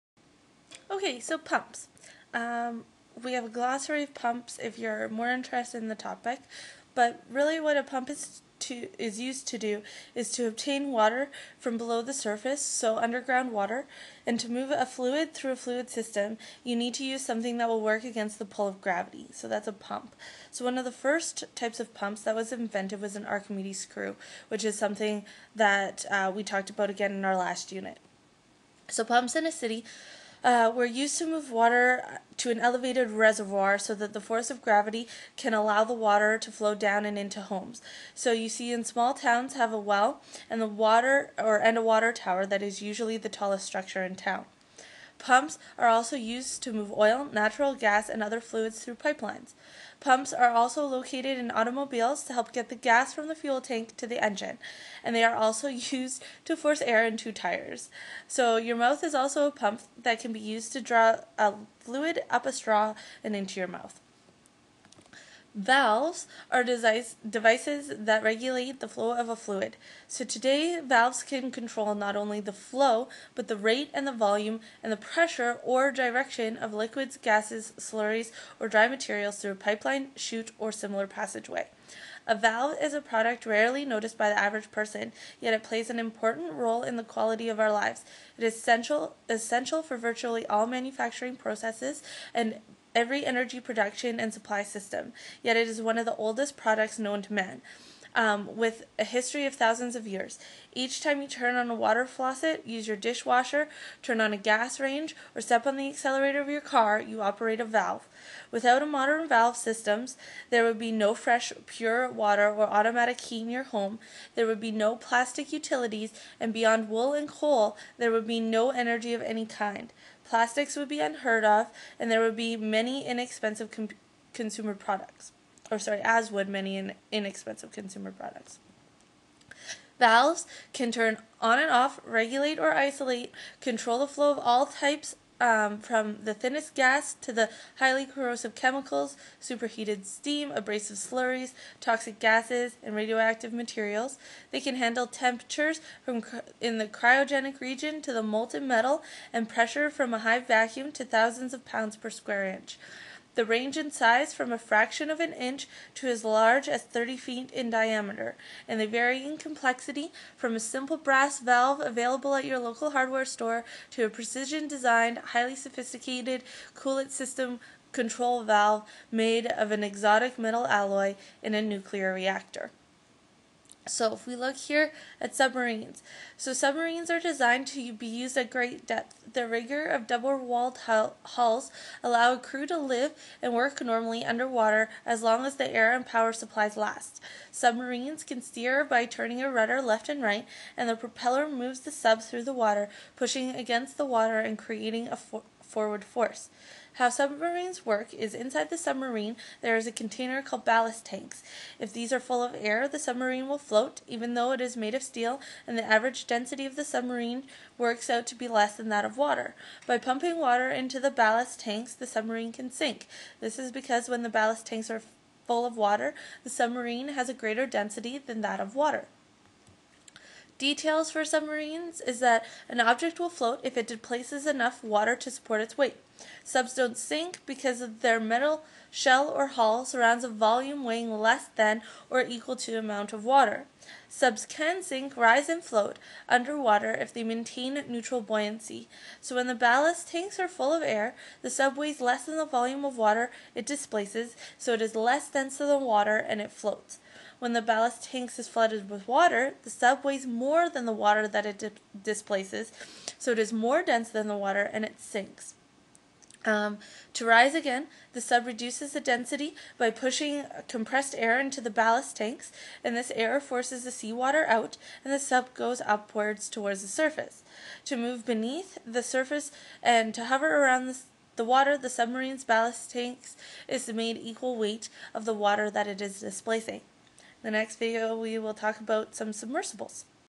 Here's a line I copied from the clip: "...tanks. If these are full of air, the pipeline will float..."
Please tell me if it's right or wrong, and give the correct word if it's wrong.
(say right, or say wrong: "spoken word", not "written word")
wrong: "submarine", not "pipeline".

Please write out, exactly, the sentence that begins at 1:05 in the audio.
Valves are devices that regulate the flow of a fluid.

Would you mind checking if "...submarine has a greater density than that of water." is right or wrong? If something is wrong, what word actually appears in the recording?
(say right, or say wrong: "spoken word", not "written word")
right.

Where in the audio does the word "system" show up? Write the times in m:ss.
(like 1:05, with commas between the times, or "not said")
0:15, 1:34, 1:49, 2:47.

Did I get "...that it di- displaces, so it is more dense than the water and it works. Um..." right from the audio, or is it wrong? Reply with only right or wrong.
wrong.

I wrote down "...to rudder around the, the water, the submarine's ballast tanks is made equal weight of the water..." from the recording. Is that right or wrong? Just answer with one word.
wrong.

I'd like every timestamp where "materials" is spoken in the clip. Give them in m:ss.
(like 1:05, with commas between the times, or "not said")
1:18, 2:23.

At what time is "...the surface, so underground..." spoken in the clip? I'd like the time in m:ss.
0:12.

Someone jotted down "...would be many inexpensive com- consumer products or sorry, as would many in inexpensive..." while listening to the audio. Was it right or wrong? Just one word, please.
right.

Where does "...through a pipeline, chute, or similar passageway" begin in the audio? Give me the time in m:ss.
1:19.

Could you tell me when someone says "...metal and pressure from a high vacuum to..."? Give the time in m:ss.
2:28.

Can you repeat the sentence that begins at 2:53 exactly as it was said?
So if we look here at submarines, so submarines are designed to be used at great depth.